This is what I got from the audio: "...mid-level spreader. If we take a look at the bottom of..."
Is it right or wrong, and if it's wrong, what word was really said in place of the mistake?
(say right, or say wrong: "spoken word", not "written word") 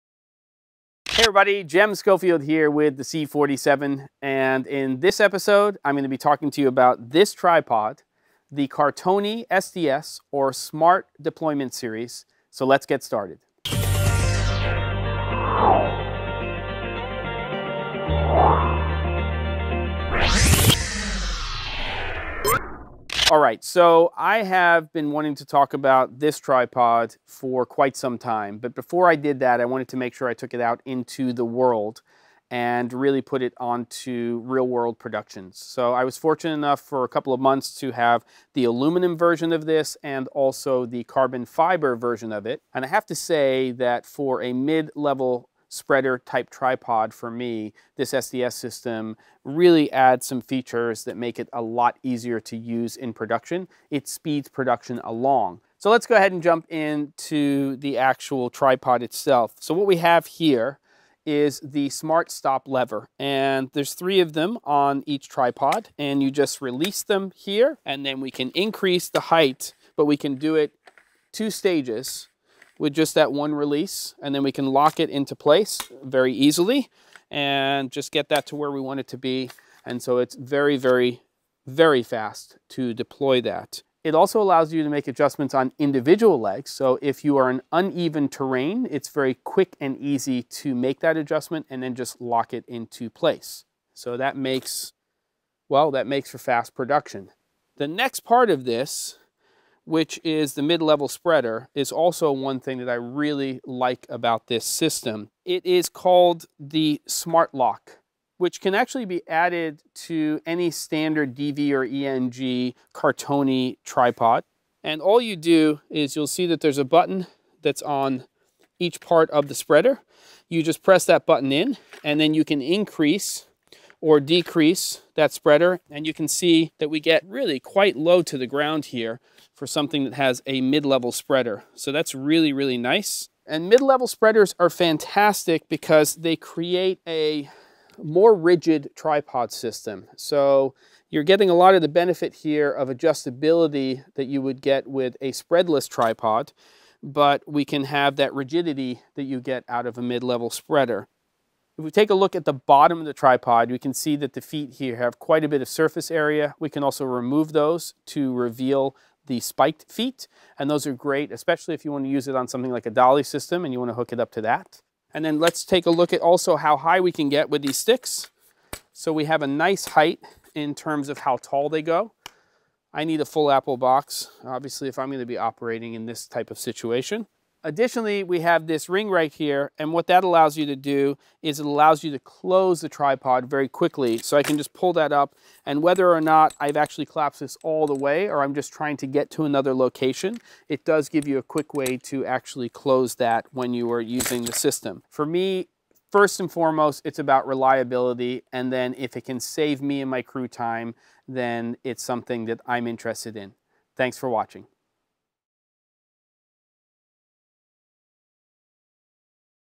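right.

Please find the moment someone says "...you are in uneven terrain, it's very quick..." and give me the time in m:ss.
1:27.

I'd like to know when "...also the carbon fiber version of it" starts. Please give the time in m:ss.
0:40.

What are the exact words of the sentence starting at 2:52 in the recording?
I need a full apple box, obviously, if I'm going to be operating in this type of situation.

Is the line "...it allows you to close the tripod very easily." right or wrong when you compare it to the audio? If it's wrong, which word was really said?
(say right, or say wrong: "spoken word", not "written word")
wrong: "quickly", not "easily".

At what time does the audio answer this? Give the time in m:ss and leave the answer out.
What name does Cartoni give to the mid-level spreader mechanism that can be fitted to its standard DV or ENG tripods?
1:47.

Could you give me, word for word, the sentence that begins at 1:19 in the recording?
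And so it's very, very, very fast to deploy that.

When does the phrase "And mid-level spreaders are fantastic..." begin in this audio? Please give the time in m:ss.
2:13.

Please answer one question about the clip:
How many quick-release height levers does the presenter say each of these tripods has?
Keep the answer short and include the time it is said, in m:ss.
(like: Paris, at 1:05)
3, at 1:03.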